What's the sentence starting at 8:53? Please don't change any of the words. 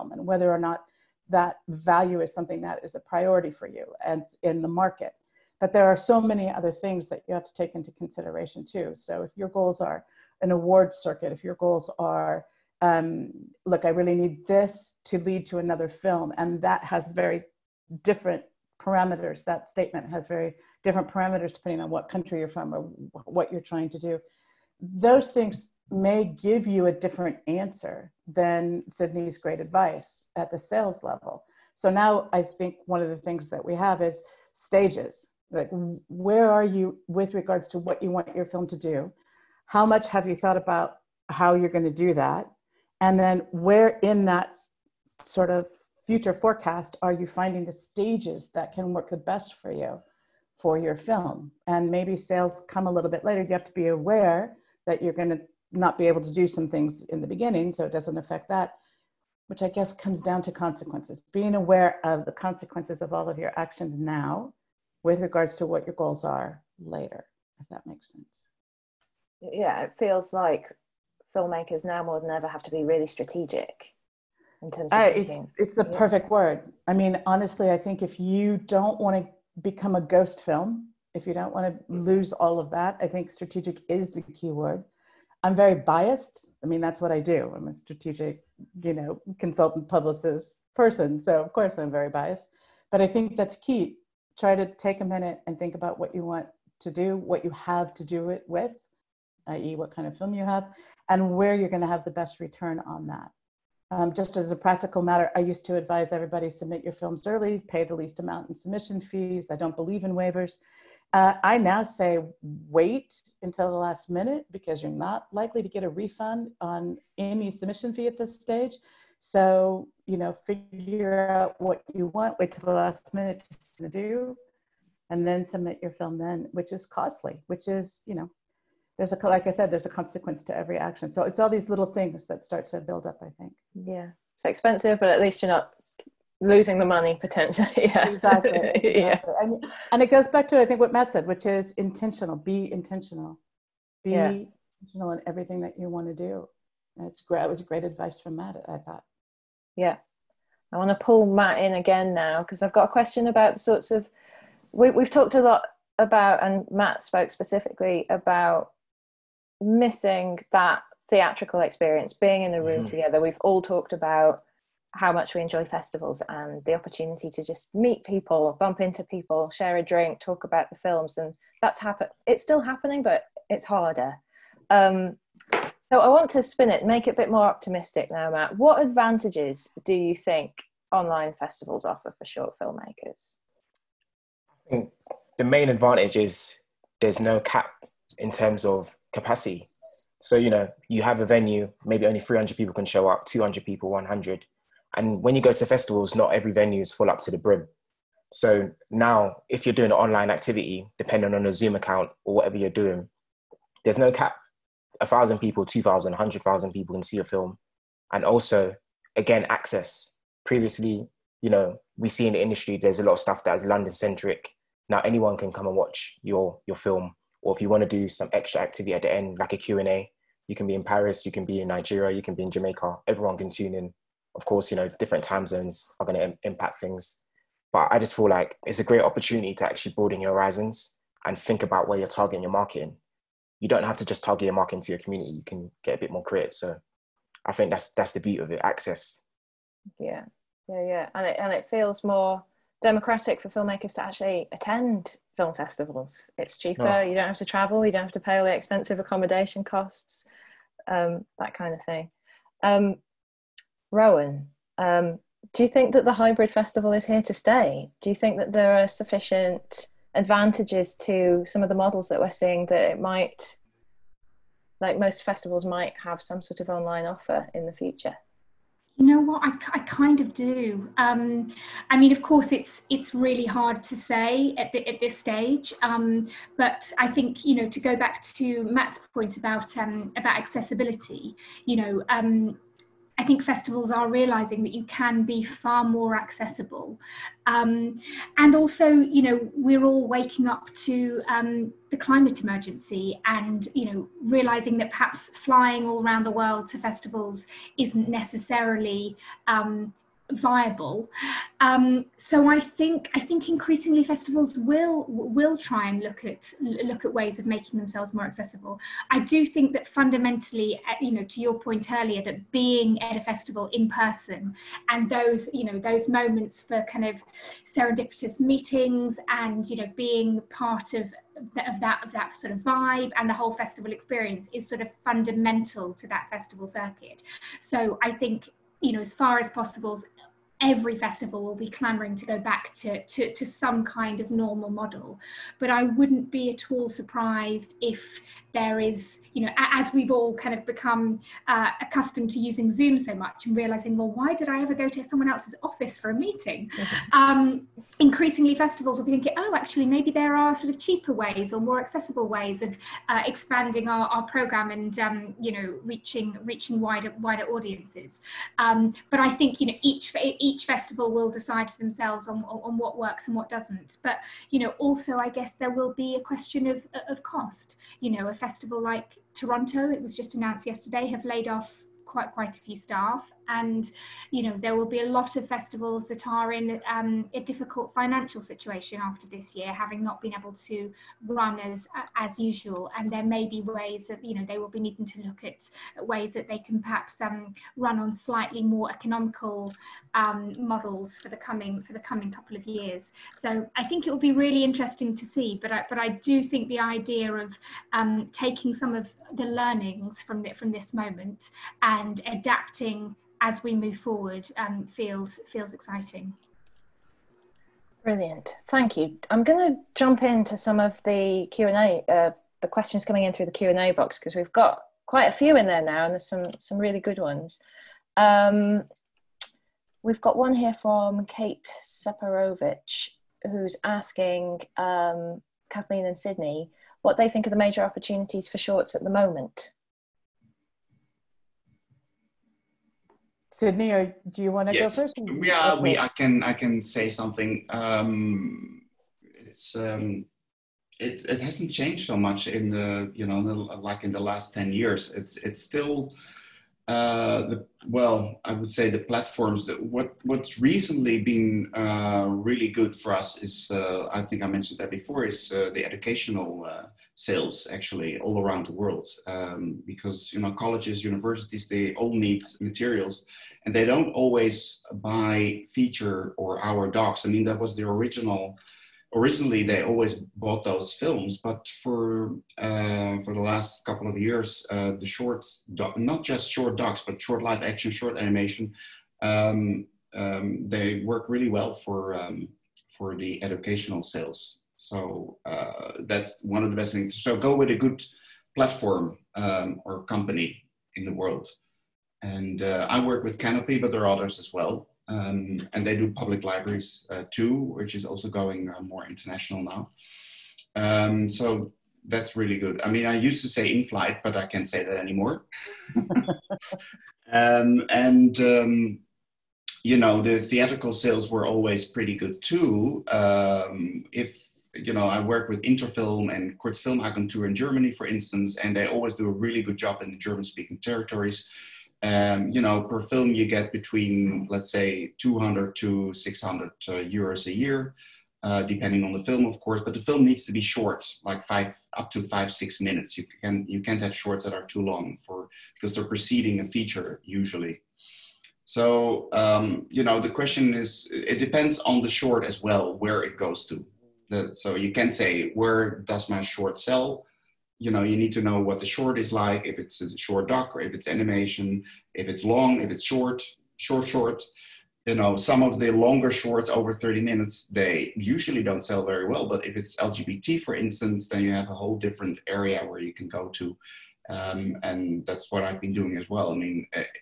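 You can you can't have shorts that are too long for because they're preceding a feature usually.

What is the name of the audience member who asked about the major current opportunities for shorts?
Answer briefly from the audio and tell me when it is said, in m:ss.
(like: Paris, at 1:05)
Kate Separovich, at 7:01.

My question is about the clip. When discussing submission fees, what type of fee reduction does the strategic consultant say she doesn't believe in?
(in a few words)
Waivers.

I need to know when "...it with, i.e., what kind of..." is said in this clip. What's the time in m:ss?
1:38.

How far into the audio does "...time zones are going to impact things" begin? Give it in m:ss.
3:45.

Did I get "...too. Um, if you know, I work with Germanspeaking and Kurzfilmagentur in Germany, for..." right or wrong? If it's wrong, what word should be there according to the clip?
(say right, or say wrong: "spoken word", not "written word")
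wrong: "Interfilm", not "Germanspeaking".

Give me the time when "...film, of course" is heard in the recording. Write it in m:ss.
8:49.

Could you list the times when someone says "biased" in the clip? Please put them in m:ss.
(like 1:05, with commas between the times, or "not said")
1:25, 1:32.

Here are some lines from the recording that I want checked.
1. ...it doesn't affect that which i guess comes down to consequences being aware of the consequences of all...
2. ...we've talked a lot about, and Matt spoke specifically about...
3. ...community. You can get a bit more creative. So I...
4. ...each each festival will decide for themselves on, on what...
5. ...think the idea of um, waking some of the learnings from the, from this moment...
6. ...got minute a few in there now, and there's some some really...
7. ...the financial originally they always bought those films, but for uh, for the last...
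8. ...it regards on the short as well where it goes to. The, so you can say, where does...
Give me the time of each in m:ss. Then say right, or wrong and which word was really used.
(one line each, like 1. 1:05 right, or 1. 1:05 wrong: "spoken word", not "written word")
1. 0:57 right
2. 2:34 right
3. 3:55 right
4. 5:59 right
5. 6:36 wrong: "taking", not "waking"
6. 6:54 wrong: "quite", not "minute"
7. 7:47 wrong: "original", not "financial"
8. 9:01 wrong: "depends", not "regards".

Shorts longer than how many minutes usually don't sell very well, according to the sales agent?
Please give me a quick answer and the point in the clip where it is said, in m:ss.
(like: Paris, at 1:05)
30 minutes, at 9:16.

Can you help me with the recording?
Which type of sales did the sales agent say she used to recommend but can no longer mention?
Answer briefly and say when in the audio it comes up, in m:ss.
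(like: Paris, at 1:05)
In flight, at 8:23.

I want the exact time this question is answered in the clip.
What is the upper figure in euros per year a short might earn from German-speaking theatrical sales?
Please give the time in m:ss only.
8:46.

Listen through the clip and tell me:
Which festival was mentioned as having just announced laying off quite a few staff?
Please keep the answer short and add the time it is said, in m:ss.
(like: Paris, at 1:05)
Toronto, at 6:09.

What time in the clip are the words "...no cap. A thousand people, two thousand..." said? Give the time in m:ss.
3:23.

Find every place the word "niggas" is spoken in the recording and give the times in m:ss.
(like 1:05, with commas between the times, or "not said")
not said.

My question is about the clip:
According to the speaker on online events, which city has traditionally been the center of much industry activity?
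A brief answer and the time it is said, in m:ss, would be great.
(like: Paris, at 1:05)
London, at 3:33.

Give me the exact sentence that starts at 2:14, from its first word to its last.
It's expensive, but at least you're not losing the money potentially.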